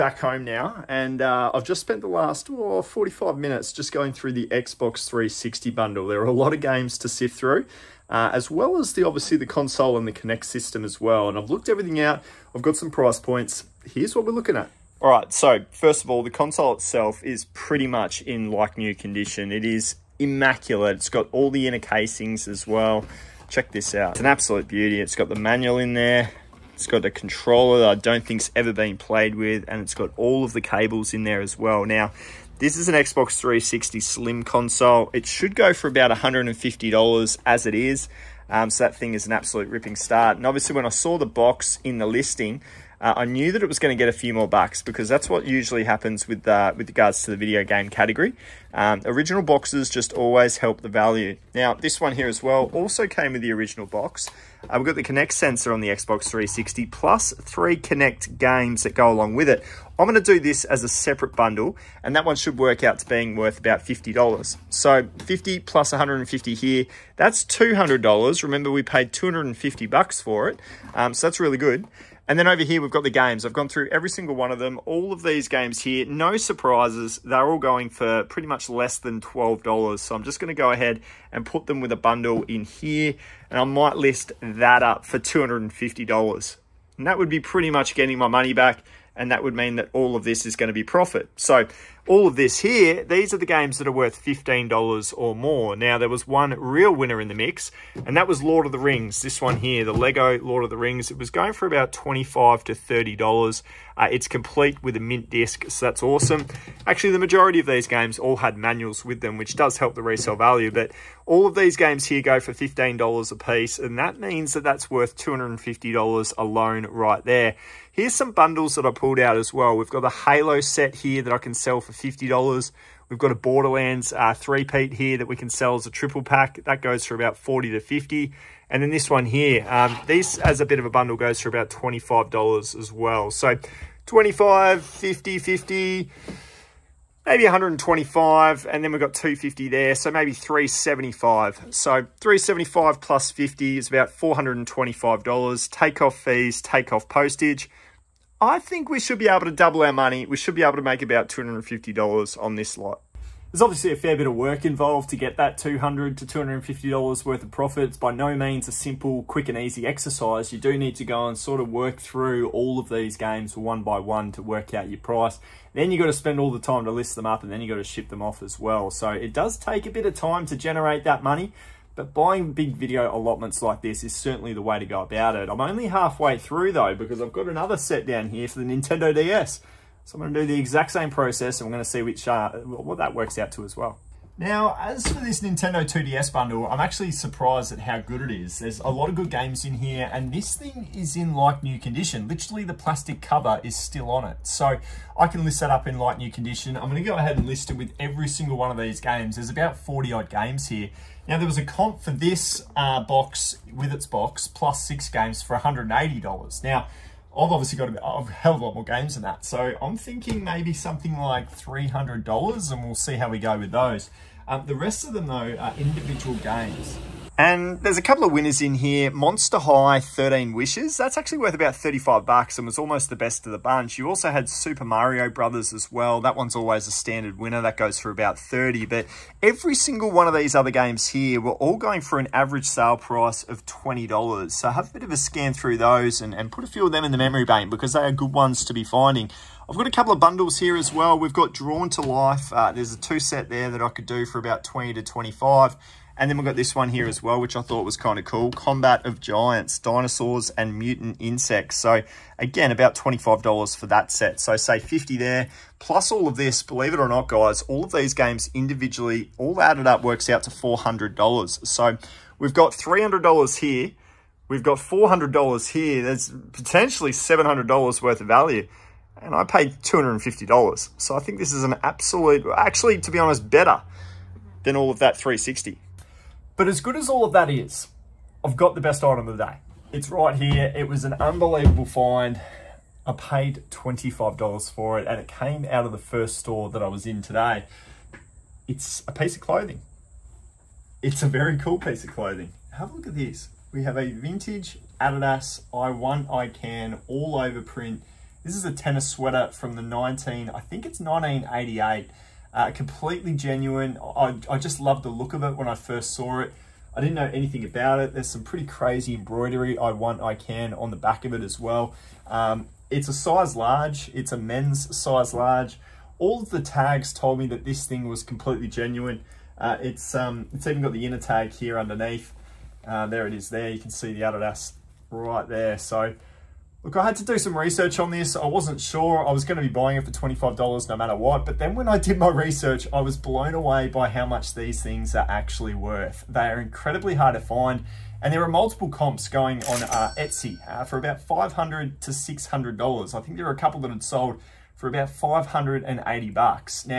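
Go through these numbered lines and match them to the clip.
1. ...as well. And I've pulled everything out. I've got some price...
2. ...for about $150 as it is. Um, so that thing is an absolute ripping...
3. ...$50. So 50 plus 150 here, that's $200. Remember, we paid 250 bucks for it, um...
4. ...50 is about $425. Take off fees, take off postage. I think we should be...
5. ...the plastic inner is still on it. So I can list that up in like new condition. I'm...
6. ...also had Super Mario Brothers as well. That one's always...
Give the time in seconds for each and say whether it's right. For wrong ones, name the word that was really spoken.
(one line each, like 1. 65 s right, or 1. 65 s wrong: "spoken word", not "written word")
1. 10 s wrong: "looked", not "pulled"
2. 35 s right
3. 63 s right
4. 143 s right
5. 192 s wrong: "cover", not "inner"
6. 224 s right.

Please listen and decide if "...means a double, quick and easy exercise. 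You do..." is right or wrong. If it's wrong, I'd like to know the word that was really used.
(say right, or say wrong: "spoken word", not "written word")
wrong: "simple", not "double".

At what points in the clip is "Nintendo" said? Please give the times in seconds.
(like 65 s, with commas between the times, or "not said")
178 s, 185 s.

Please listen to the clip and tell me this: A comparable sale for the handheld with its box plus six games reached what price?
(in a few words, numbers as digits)
$180.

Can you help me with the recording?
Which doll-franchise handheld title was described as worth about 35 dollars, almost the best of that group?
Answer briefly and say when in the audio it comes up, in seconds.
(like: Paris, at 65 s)
Monster High 13 Wishes, at 219 s.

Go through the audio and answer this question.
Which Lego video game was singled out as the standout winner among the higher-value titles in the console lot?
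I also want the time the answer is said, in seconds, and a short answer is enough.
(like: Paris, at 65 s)
Lego Lord of the Rings, at 99 s.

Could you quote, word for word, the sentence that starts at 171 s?
But buying big video allotments like this is certainly the way to go about it.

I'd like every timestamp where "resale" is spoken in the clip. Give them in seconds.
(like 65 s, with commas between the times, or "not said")
110 s.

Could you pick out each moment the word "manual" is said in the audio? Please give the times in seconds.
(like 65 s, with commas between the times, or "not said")
25 s, 108 s.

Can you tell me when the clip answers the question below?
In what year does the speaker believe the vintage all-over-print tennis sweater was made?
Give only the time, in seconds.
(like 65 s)
301 s.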